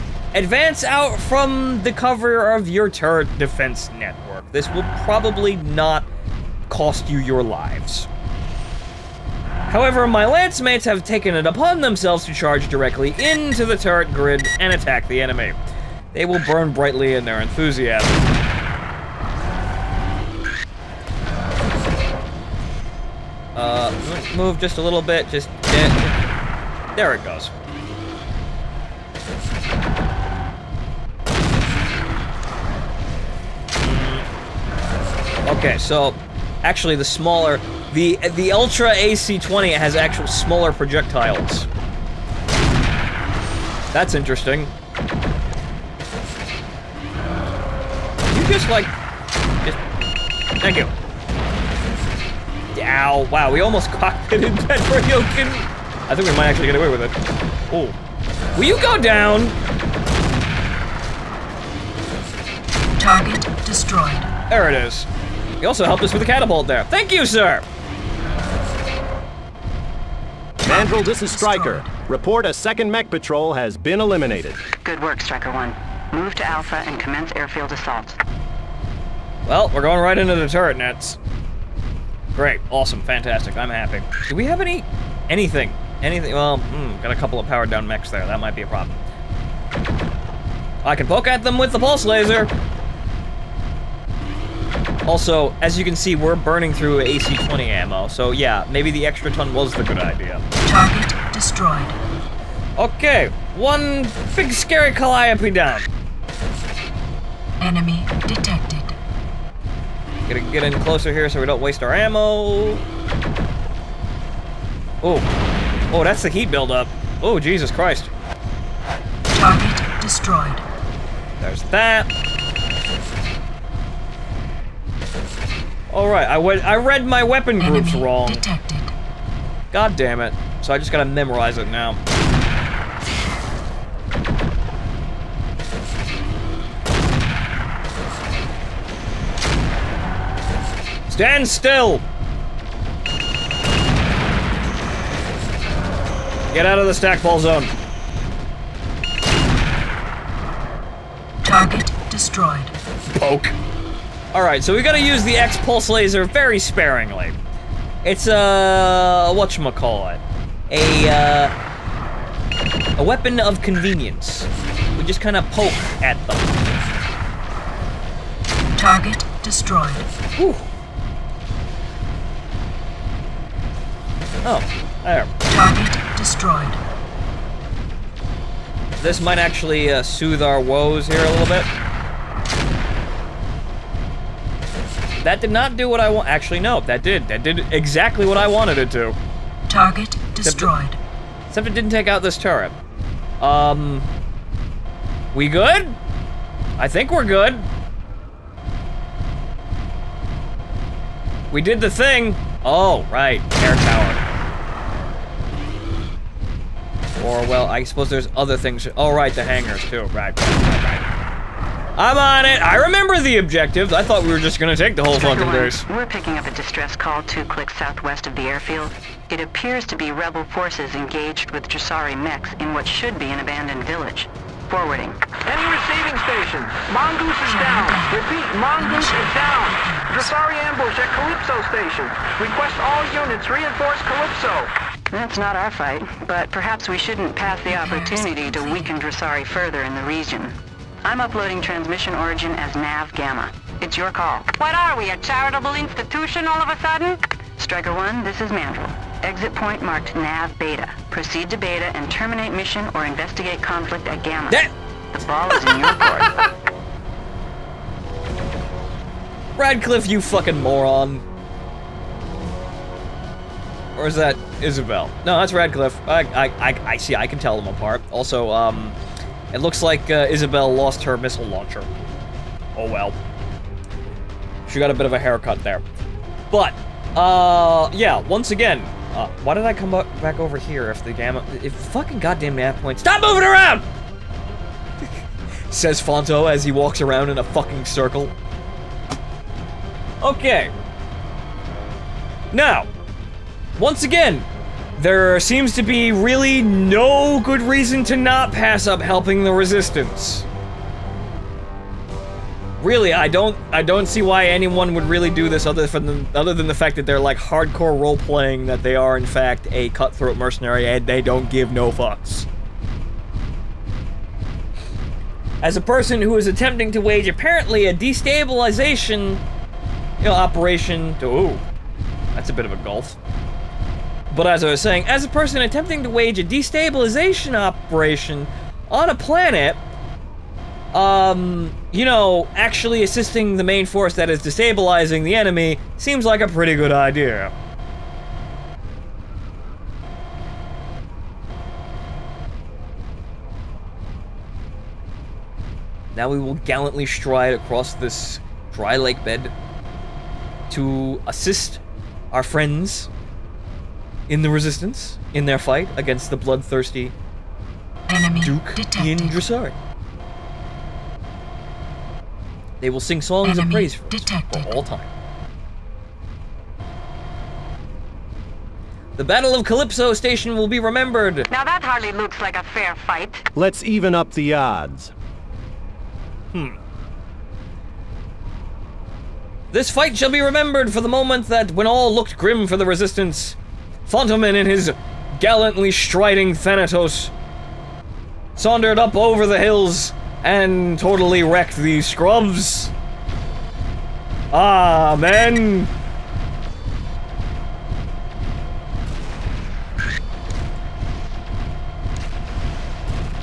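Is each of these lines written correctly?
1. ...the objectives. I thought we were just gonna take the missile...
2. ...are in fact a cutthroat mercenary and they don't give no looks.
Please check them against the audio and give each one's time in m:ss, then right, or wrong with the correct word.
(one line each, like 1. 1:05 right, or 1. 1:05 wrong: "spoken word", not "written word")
1. 3:33 wrong: "whole", not "missile"
2. 5:08 wrong: "fucks", not "looks".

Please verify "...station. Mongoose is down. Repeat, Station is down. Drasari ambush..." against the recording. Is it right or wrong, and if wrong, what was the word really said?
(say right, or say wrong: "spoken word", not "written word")
wrong: "Mongoose", not "Station".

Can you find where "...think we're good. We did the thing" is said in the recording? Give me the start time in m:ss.
3:16.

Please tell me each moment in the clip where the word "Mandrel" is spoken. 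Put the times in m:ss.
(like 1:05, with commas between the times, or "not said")
1:10, 4:08.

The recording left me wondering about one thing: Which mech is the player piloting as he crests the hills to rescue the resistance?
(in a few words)
Thanatos.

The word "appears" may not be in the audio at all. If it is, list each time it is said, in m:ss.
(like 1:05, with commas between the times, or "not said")
3:39.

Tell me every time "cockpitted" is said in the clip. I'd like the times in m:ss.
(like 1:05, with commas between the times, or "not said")
0:53.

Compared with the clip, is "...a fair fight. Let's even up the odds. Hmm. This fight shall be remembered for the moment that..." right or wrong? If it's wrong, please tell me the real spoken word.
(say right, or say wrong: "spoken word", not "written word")
right.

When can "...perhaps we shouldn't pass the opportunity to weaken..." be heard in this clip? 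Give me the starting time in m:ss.
3:56.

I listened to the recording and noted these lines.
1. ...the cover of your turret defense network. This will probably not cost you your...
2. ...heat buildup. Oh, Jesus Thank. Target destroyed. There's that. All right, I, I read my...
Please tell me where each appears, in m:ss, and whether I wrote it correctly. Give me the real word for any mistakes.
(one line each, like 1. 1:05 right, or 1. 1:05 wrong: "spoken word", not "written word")
1. 0:01 right
2. 1:56 wrong: "Christ", not "Thank".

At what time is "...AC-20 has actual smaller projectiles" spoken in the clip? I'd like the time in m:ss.
0:38.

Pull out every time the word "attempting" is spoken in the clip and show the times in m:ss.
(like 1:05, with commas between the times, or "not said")
5:16, 5:25.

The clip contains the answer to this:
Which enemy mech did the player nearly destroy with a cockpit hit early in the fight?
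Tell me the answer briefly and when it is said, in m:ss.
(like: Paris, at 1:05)
Ryoken, at 0:54.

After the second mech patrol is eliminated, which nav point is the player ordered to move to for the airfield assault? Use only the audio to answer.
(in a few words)
Alpha.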